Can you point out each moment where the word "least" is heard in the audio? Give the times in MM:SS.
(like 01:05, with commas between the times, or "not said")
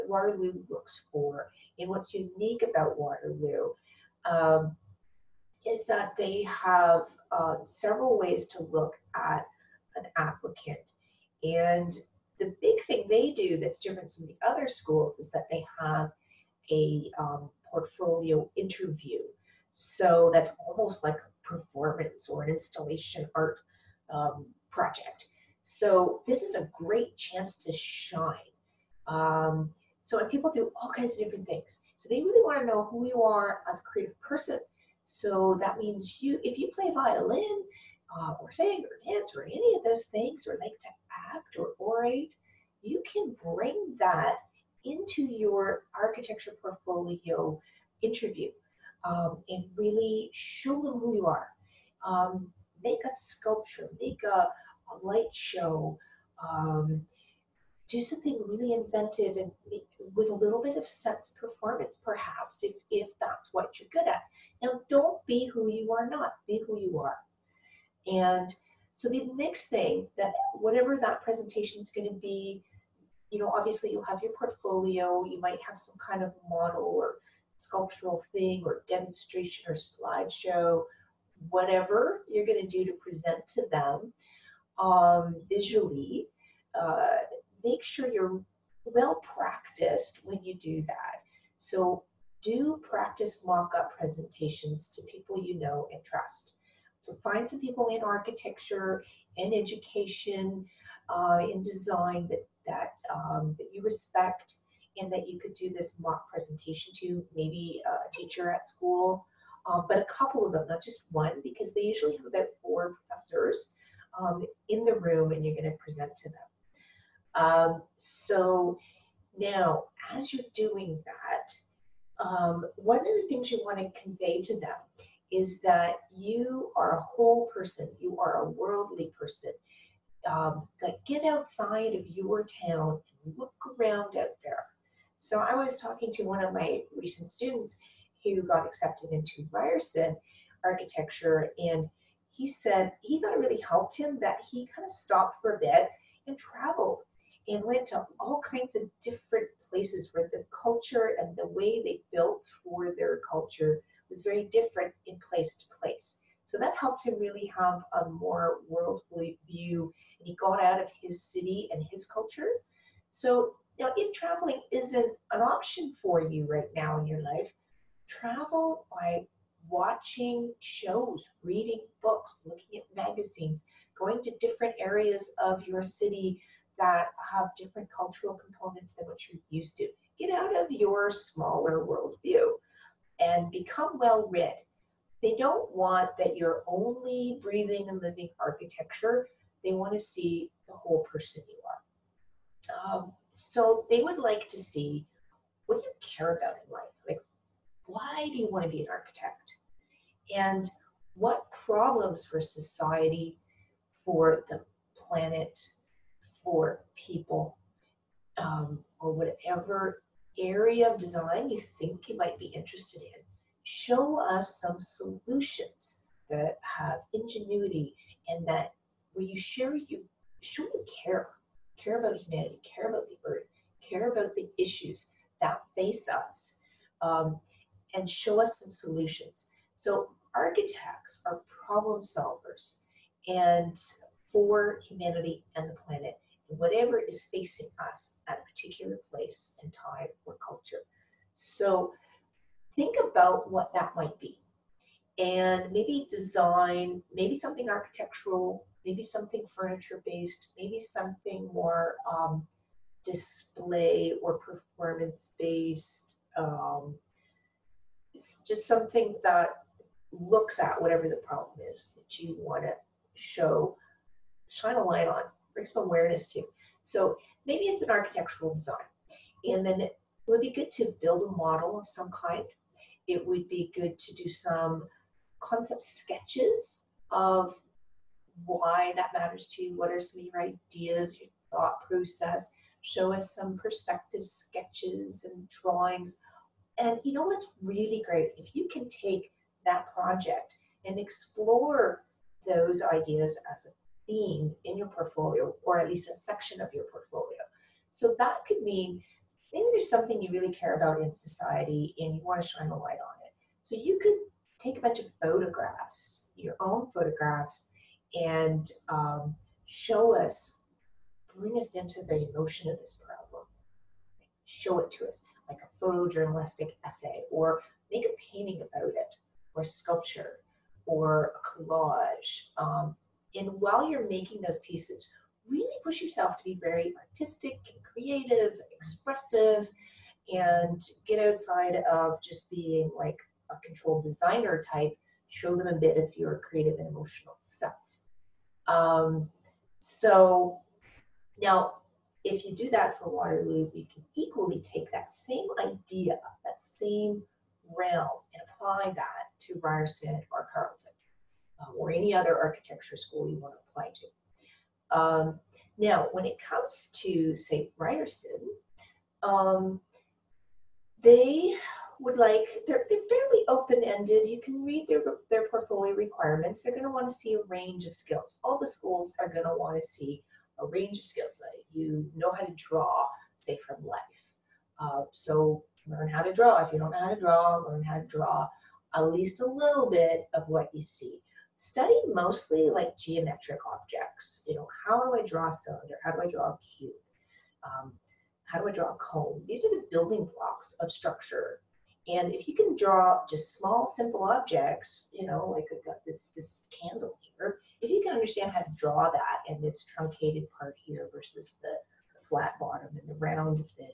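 04:55, 06:19.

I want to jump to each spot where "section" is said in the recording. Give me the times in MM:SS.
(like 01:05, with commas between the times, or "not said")
04:56.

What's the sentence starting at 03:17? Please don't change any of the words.
Like, why do you want to be an architect?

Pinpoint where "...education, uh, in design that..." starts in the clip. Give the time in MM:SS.
01:39.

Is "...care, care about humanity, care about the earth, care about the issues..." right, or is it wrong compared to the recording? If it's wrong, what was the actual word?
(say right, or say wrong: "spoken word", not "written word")
right.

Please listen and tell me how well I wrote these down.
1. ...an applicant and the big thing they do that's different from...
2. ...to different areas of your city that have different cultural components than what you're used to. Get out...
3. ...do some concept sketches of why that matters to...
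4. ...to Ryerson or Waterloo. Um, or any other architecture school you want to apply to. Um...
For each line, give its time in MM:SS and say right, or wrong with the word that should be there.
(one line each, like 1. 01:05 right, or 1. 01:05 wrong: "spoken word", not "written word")
1. 00:09 right
2. 02:54 right
3. 04:34 right
4. 05:49 wrong: "Carleton", not "Waterloo".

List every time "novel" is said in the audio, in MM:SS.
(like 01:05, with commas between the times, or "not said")
not said.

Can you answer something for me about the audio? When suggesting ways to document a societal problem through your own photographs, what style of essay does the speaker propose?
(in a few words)
photojournalistic essay.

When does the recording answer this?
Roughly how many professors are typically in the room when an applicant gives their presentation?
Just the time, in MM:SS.
01:52.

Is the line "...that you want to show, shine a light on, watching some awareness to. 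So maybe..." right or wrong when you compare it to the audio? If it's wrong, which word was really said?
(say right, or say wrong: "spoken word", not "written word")
wrong: "bring", not "watching".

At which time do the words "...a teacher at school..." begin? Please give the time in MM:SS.
01:47.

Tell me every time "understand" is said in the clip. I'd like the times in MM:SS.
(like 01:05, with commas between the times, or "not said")
06:38.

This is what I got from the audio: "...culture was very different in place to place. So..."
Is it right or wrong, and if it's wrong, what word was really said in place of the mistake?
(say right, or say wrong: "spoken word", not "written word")
right.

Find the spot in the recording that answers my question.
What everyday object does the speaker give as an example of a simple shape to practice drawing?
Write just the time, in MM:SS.
06:36.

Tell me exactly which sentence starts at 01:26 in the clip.
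Uh, make sure you're well practiced when you do that.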